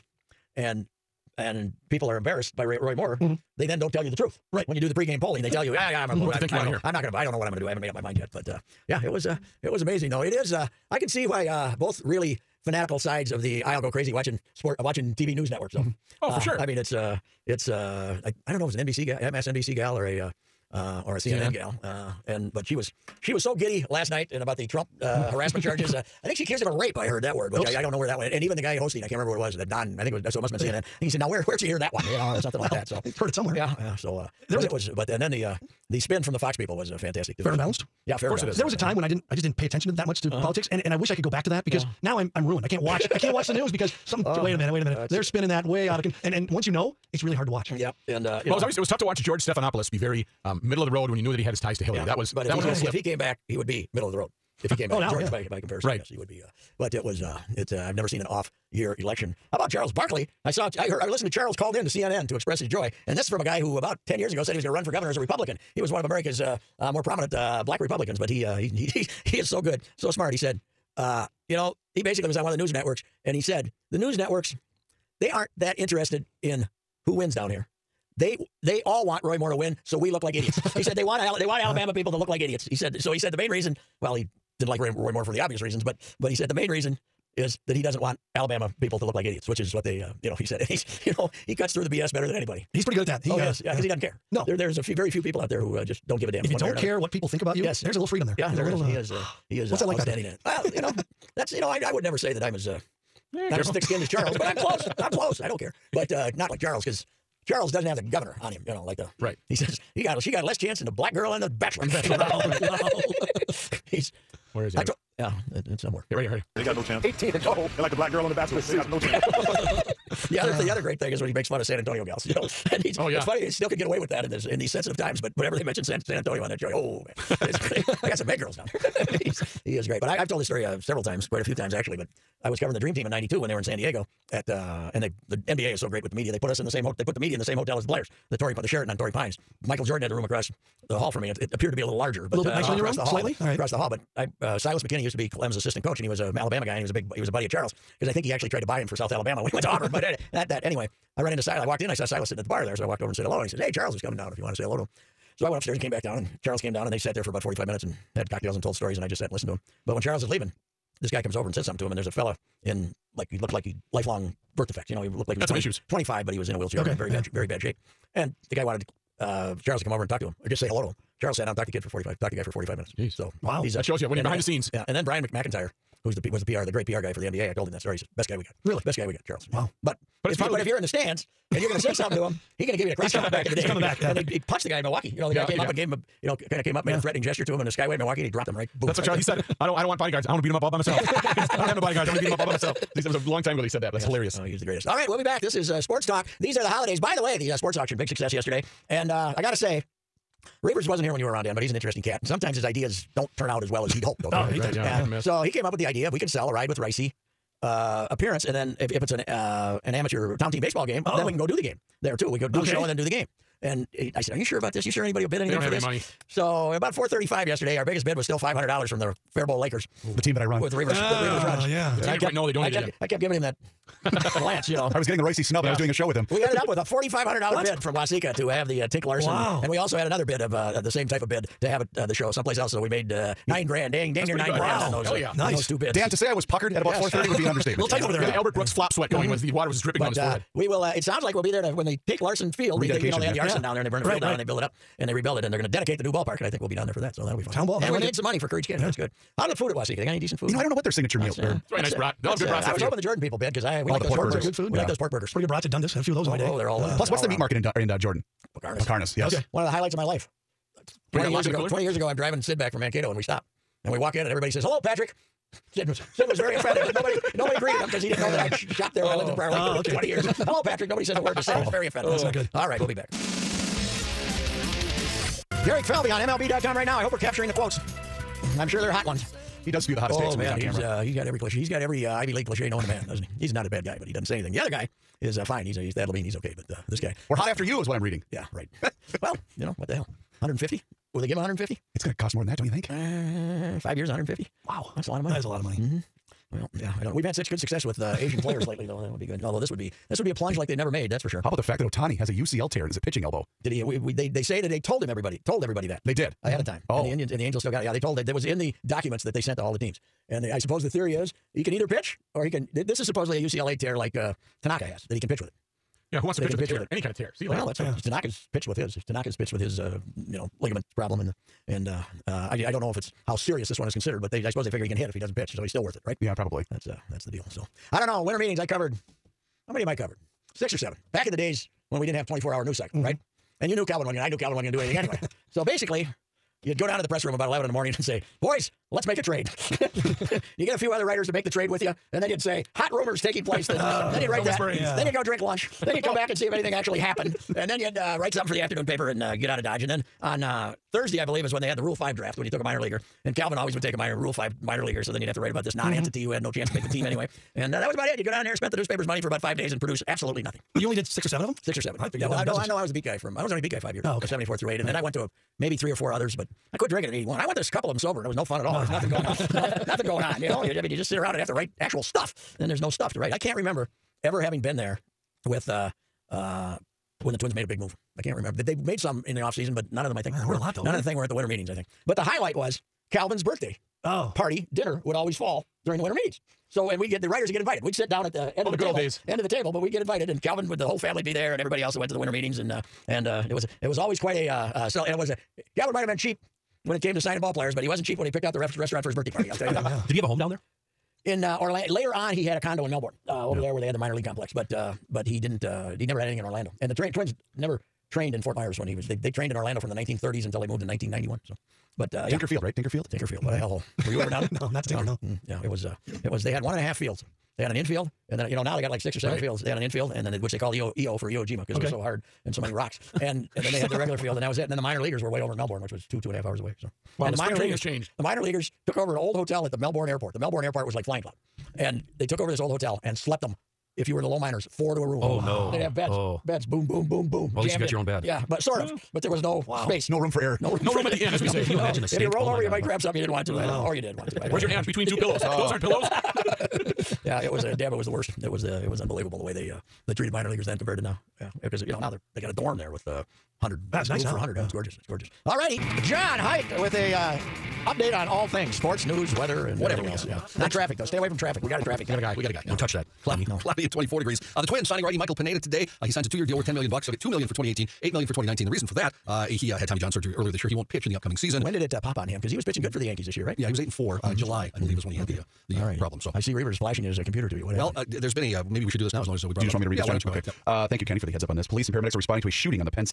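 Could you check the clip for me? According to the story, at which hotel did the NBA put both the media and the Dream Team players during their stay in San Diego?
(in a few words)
Sheraton on Torrey Pines.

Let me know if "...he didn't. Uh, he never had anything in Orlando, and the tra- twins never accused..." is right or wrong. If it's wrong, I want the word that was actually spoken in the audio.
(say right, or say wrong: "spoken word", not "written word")
wrong: "trained", not "accused".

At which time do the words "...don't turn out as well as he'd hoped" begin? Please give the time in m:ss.
3:23.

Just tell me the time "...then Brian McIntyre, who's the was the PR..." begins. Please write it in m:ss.
2:54.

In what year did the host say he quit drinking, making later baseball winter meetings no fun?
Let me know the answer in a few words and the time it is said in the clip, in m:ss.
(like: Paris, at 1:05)
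1981, at 6:07.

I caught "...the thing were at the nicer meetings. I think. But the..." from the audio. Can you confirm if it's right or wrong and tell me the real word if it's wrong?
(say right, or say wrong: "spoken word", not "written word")
wrong: "winter", not "nicer".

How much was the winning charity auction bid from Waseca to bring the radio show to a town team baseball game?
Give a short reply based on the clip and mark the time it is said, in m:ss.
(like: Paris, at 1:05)
$4,500, at 3:46.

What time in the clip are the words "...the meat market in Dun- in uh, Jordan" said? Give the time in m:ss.
4:17.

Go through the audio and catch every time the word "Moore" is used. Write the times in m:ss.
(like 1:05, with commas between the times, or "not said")
0:02, 1:19, 1:25.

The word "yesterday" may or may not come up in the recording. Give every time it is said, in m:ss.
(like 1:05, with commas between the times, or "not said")
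3:18, 3:37.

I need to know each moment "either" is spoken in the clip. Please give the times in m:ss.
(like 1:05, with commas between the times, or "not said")
5:11.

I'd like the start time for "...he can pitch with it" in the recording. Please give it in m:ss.
5:15.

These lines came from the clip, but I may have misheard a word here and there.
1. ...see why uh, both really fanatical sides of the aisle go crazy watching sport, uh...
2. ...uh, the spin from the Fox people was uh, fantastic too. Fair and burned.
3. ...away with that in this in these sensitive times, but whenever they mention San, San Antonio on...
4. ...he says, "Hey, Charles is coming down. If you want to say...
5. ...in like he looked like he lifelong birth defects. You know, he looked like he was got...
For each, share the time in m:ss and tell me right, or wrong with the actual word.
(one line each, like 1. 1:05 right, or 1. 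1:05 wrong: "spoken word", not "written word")
1. 0:11 right
2. 0:35 wrong: "balanced", not "burned"
3. 2:03 right
4. 2:33 right
5. 2:42 right.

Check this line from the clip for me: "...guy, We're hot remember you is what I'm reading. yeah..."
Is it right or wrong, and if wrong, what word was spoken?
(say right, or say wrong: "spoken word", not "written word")
wrong: "after", not "remember".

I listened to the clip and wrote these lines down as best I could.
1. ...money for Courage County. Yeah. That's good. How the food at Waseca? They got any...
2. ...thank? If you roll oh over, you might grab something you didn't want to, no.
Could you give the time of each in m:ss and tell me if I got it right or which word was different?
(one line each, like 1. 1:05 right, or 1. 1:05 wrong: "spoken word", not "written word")
1. 4:08 right
2. 7:22 wrong: "stink", not "thank".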